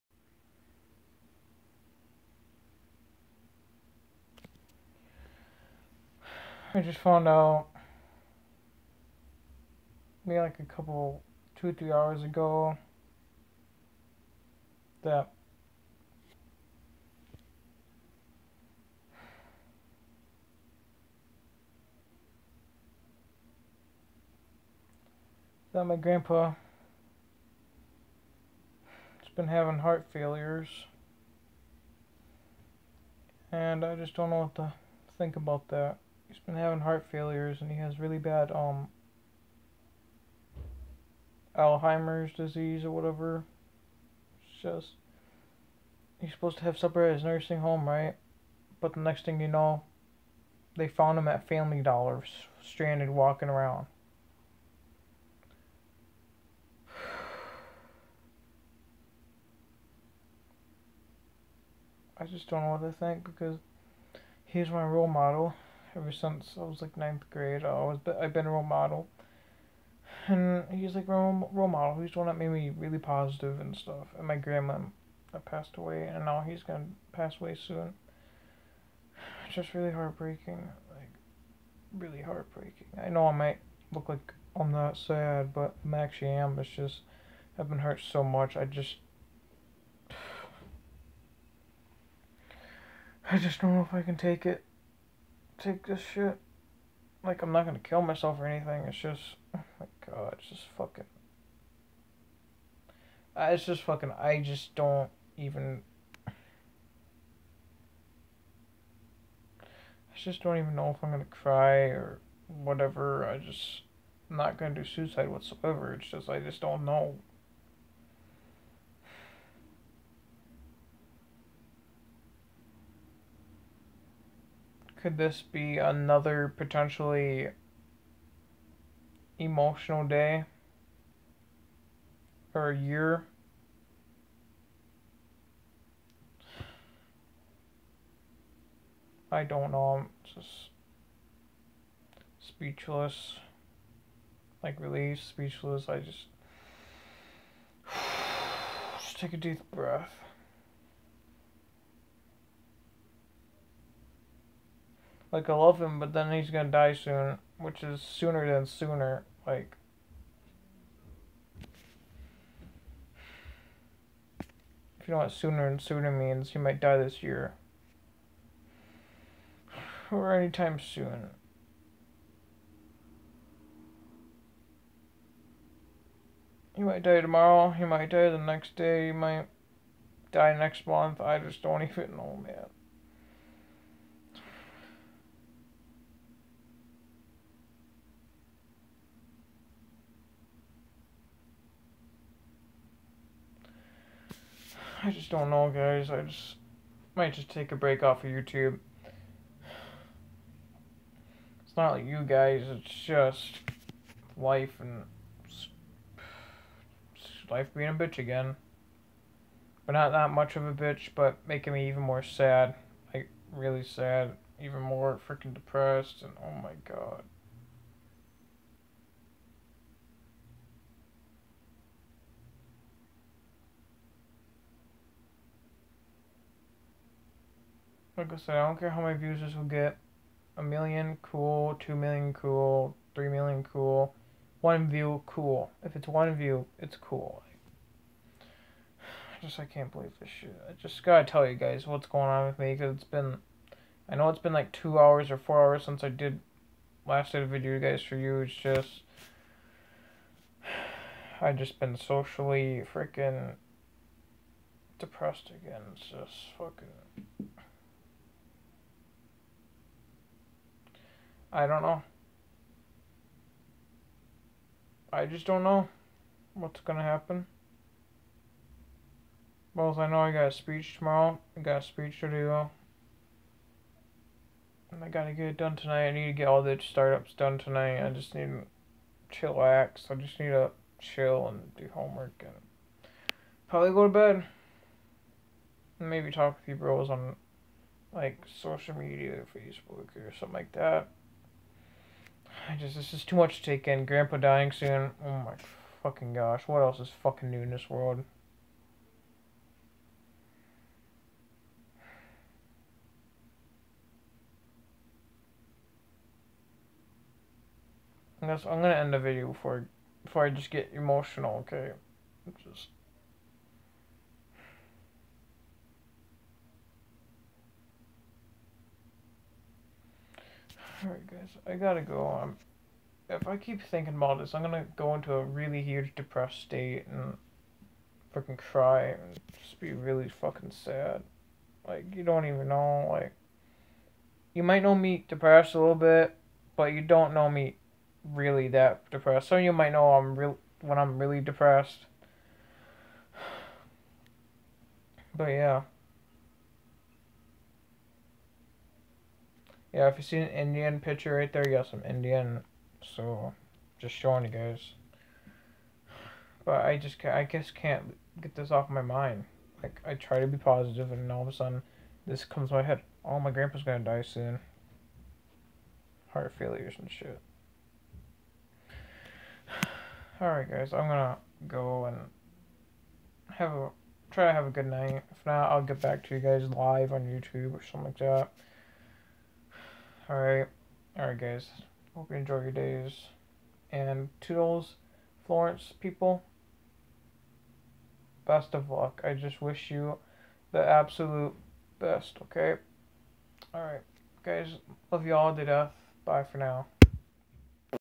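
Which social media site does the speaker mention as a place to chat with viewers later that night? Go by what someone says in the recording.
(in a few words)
Facebook.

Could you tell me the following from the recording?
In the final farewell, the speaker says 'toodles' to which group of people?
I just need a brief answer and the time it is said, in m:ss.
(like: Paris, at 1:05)
Florence people, at 6:25.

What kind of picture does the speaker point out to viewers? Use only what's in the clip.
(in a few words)
An Indian picture.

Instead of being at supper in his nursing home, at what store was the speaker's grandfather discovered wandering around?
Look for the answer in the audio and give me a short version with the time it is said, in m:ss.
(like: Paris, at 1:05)
Family Dollar, at 0:51.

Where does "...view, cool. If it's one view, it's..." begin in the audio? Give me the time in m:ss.
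3:54.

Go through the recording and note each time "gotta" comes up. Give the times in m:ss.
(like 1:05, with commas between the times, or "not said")
4:01, 4:35, 5:21.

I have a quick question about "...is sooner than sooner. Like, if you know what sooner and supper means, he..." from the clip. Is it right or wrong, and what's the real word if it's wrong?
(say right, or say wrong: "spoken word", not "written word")
wrong: "sooner", not "supper".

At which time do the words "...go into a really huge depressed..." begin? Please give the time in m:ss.
5:24.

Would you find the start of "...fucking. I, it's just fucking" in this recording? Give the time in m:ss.
1:40.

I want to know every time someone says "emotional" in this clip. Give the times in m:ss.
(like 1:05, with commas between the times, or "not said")
2:09, 5:10.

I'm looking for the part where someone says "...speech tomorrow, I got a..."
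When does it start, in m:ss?
4:30.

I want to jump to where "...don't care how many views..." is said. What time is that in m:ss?
3:48.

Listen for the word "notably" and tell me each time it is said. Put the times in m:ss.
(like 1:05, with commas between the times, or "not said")
not said.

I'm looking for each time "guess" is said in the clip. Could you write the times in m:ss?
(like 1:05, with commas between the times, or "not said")
5:08, 5:57.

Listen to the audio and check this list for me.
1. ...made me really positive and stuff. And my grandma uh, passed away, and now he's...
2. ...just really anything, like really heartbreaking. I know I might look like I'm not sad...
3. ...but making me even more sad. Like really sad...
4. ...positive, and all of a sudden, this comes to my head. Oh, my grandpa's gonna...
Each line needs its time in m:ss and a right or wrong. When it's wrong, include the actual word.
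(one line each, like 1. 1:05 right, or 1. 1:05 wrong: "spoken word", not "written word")
1. 1:12 right
2. 1:19 wrong: "heartbreaking", not "anything"
3. 3:31 right
4. 6:00 right.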